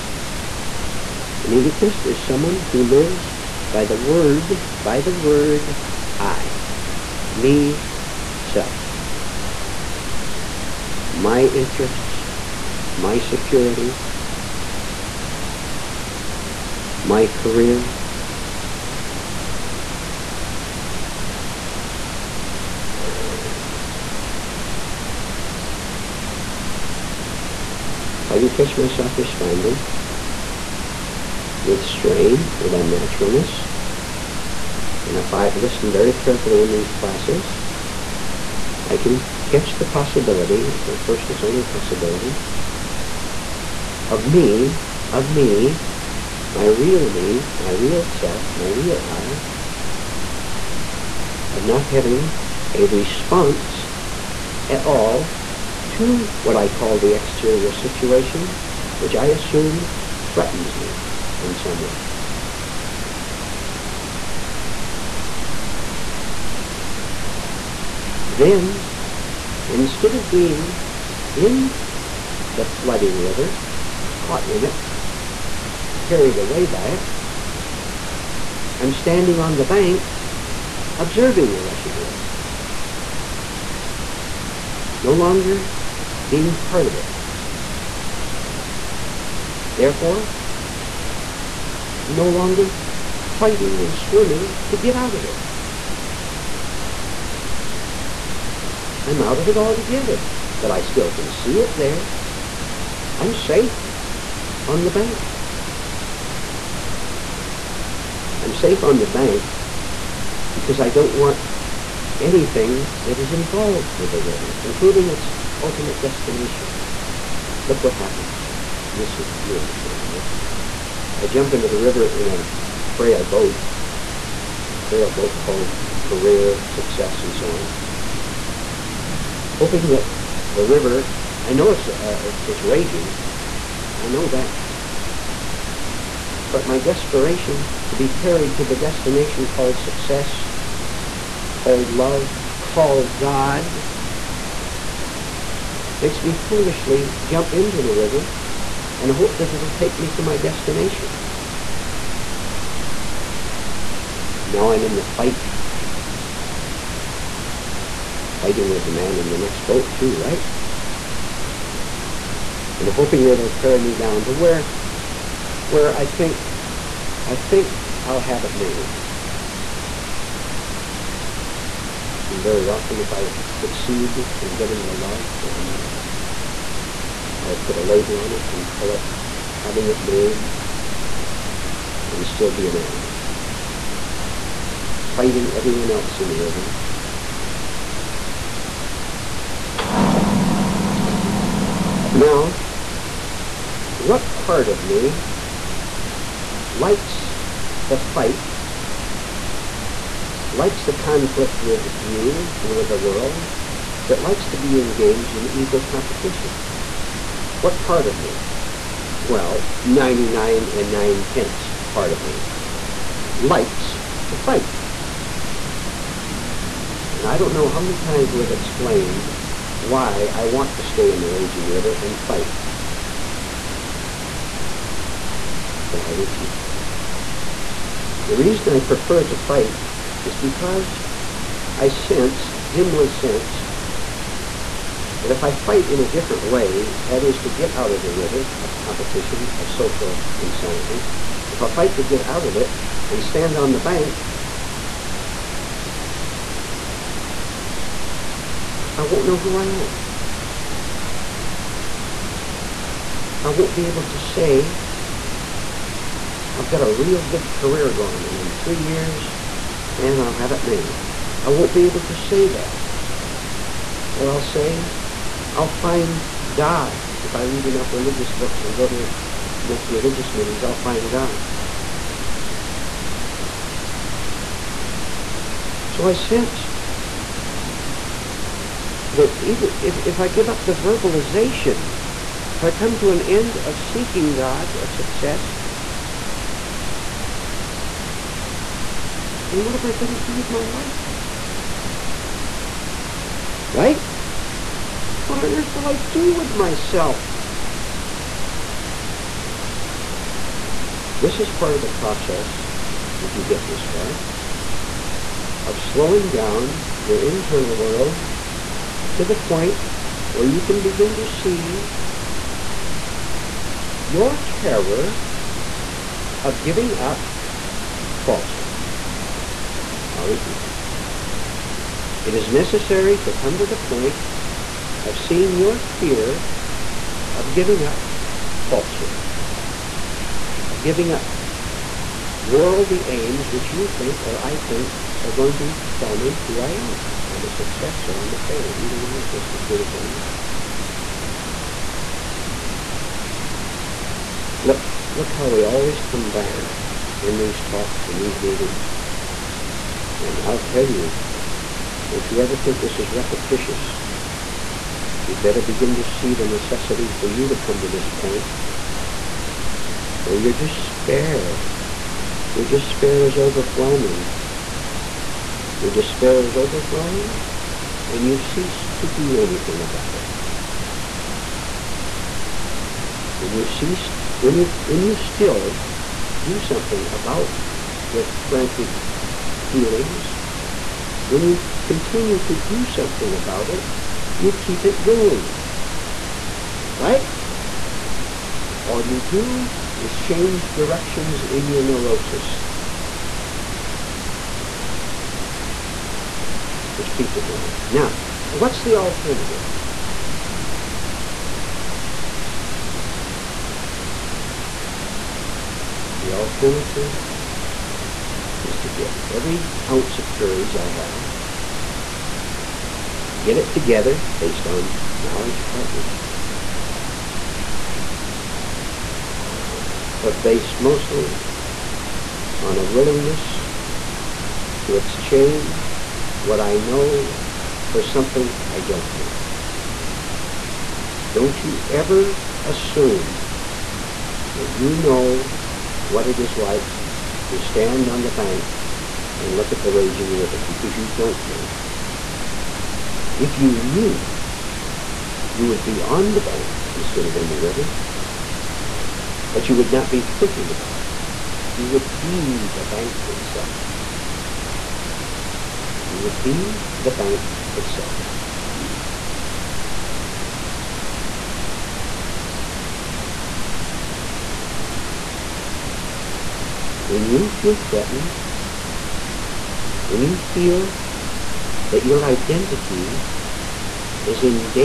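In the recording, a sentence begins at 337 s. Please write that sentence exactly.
I'm a success or I'm a failure.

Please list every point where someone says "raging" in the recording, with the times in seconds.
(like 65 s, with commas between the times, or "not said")
132 s, 221 s, 439 s.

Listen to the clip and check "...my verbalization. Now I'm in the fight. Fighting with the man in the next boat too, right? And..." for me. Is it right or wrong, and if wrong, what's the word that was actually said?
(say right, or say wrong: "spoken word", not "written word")
wrong: "destination", not "verbalization".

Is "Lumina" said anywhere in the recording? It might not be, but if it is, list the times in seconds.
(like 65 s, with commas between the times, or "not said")
not said.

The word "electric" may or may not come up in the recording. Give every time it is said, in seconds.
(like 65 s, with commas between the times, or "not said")
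not said.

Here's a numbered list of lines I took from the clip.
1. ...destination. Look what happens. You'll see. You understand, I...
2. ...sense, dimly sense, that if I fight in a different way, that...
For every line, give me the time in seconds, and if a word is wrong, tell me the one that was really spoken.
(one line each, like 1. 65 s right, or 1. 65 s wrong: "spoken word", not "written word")
1. 116 s right
2. 231 s right.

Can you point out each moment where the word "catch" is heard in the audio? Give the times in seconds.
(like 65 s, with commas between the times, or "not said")
28 s, 39 s.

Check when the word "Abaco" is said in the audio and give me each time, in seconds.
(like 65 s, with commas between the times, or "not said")
not said.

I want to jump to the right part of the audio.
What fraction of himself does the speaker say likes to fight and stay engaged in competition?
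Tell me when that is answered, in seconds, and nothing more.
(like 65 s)
209 s.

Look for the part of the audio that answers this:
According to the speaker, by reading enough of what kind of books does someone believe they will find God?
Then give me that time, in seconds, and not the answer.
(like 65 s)
267 s.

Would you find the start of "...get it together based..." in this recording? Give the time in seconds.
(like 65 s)
413 s.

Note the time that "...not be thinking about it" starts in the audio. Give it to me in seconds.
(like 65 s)
449 s.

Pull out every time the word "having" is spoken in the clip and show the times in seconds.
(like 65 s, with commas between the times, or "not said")
51 s, 179 s.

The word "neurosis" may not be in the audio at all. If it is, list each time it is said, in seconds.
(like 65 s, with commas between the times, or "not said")
391 s.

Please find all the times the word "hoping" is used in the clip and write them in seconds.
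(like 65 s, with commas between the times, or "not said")
129 s, 162 s.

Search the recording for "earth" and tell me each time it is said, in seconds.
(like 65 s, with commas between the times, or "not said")
295 s.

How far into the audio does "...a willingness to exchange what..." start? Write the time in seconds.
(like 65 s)
422 s.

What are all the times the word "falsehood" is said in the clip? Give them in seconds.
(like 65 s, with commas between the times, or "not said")
318 s, 328 s.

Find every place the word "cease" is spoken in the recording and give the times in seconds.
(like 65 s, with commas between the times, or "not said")
368 s, 373 s.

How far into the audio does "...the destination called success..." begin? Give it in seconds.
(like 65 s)
138 s.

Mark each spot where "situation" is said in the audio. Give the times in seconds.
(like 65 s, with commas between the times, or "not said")
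57 s.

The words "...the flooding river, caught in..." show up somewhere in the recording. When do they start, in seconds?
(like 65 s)
72 s.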